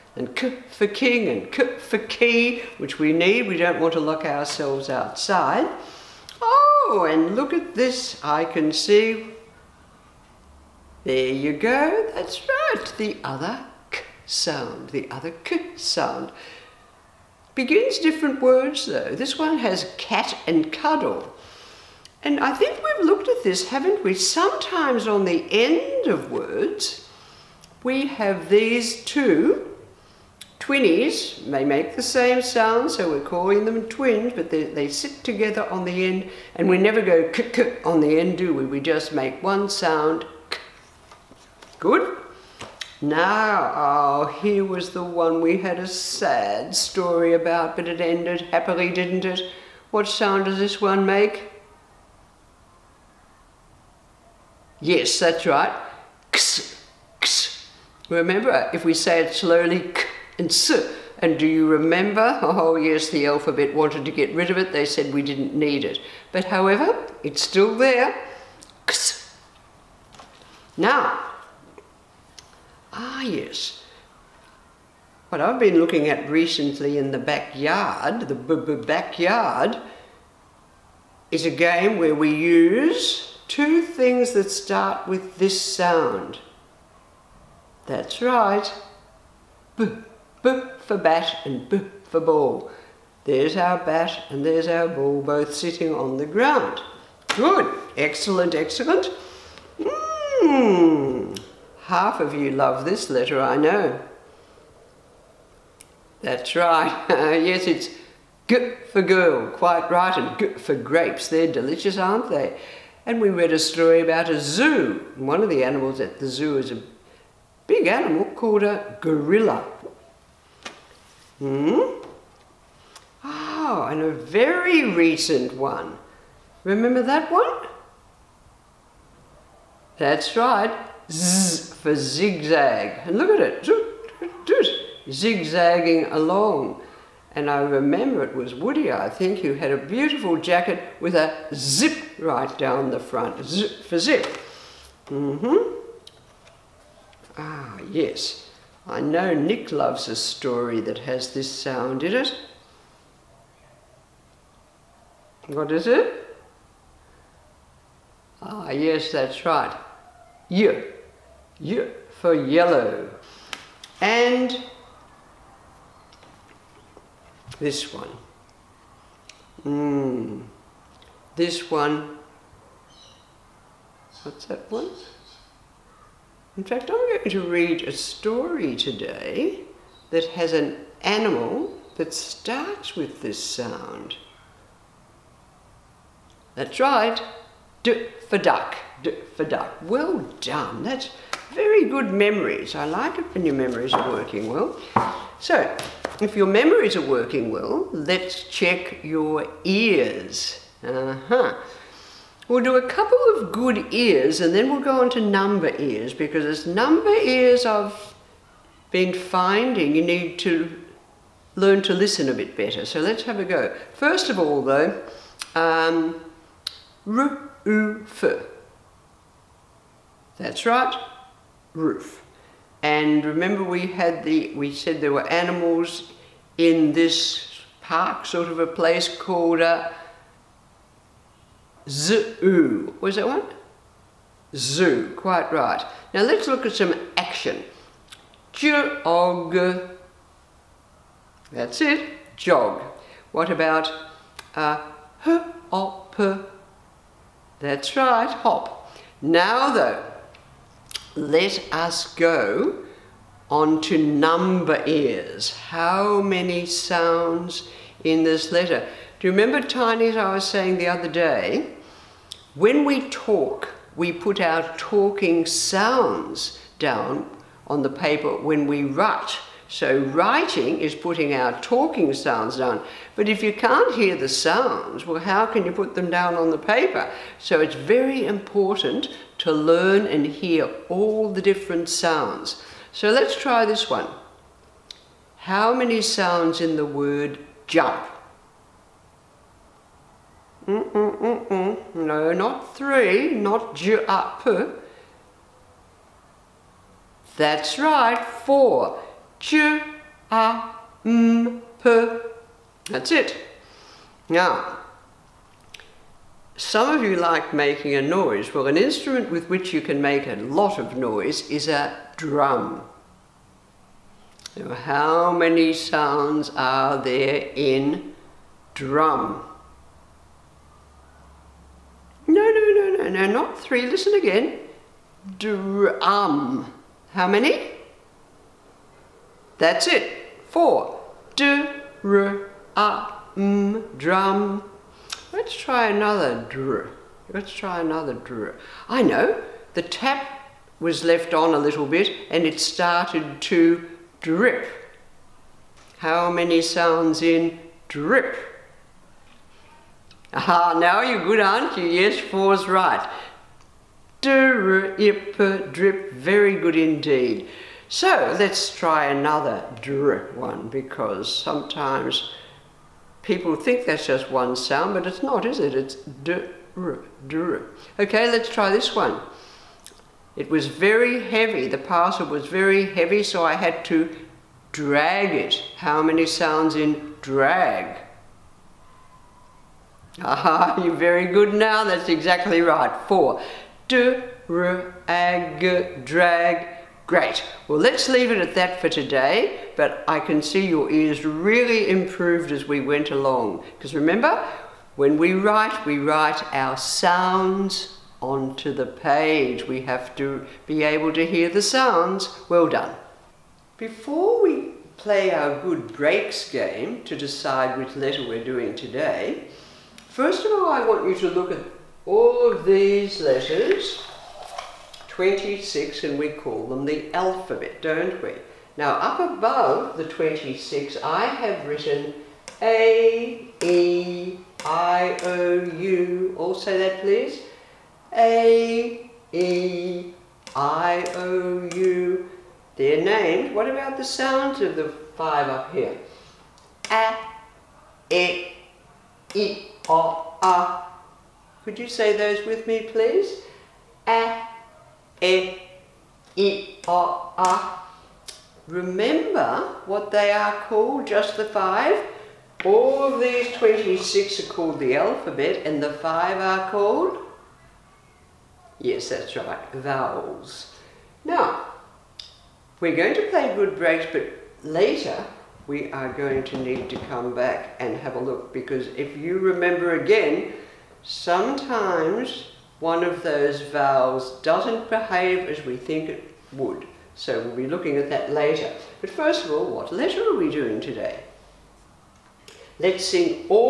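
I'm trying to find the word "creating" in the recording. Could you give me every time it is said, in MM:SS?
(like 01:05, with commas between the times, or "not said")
not said.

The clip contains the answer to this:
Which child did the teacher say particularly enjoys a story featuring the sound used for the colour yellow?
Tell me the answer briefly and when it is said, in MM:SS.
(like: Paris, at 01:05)
Nick, at 02:29.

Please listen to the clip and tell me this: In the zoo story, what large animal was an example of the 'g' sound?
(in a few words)
gorilla.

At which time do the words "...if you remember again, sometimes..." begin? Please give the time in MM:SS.
07:48.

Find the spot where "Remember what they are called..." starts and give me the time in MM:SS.
07:28.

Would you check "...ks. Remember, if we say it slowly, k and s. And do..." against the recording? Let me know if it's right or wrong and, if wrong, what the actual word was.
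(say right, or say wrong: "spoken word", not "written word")
right.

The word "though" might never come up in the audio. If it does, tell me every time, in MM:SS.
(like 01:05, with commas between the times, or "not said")
00:18, 03:34, 04:09.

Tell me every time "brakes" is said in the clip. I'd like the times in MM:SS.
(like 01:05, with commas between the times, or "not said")
06:45, 07:43.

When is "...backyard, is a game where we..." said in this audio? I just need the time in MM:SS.
01:18.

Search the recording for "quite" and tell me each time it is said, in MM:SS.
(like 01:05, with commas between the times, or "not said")
01:49, 03:55.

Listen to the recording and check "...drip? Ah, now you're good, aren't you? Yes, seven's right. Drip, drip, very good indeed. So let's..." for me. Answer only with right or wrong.
wrong.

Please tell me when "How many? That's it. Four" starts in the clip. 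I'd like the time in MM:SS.
05:27.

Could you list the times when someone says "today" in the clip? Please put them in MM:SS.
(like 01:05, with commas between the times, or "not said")
02:58, 06:28, 06:48, 08:00.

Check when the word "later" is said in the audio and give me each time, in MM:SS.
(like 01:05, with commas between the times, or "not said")
07:44, 07:58.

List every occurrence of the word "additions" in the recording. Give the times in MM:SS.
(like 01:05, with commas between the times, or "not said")
not said.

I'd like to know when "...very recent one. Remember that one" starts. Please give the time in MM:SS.
02:04.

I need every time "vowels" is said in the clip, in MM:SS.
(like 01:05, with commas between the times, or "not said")
07:39, 07:53.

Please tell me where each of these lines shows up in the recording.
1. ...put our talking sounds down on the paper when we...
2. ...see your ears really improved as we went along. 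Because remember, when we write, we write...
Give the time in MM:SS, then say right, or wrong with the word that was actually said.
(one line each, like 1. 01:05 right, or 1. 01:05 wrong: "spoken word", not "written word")
1. 04:24 right
2. 06:30 right.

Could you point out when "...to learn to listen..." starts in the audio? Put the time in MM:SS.
03:30.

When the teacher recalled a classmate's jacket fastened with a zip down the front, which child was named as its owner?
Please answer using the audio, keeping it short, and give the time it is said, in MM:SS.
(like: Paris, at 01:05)
Woody, at 02:18.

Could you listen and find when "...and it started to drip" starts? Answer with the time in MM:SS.
05:42.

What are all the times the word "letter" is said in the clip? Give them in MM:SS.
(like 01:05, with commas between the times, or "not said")
01:43, 04:18, 06:47, 06:53, 07:59.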